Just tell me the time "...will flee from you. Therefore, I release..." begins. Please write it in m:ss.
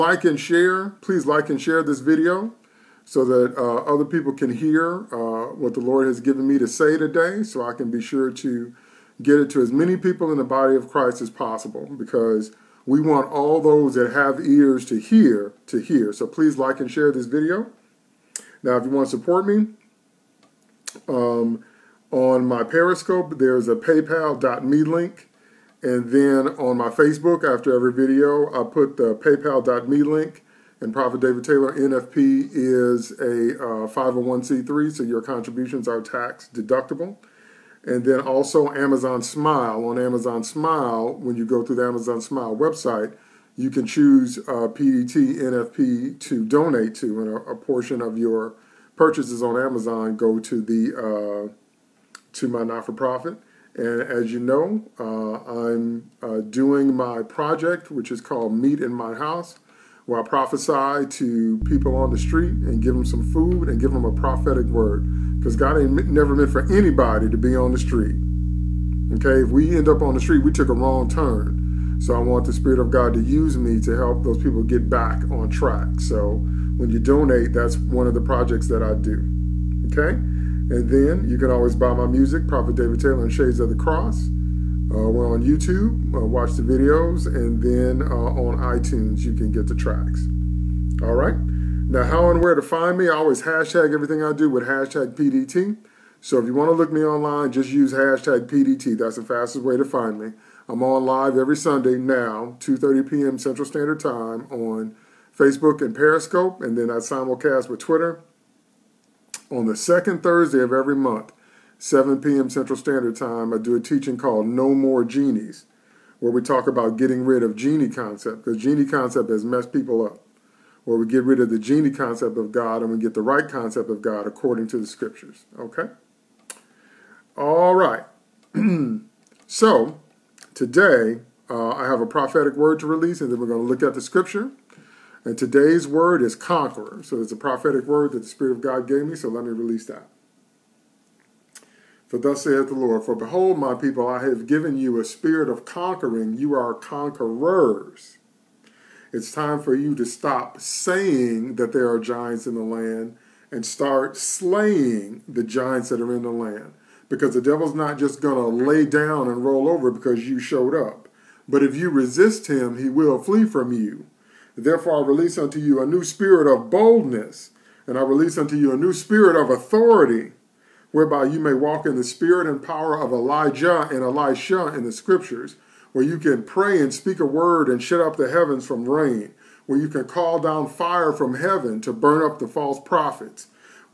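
2:42.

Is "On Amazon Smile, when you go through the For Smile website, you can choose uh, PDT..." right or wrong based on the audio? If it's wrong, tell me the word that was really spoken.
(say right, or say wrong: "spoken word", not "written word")
wrong: "Amazon", not "For".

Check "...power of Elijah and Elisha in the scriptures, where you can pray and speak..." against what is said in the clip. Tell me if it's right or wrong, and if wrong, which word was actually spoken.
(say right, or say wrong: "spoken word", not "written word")
right.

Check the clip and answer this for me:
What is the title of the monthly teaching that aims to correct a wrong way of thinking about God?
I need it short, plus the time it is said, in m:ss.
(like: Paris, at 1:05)
No More Genies, at 1:54.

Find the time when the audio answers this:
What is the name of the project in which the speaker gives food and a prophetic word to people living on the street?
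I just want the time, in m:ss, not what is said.
0:58.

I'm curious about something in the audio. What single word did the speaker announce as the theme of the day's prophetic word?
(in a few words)
Conqueror.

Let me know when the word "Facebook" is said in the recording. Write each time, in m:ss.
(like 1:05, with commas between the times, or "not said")
0:26, 1:45.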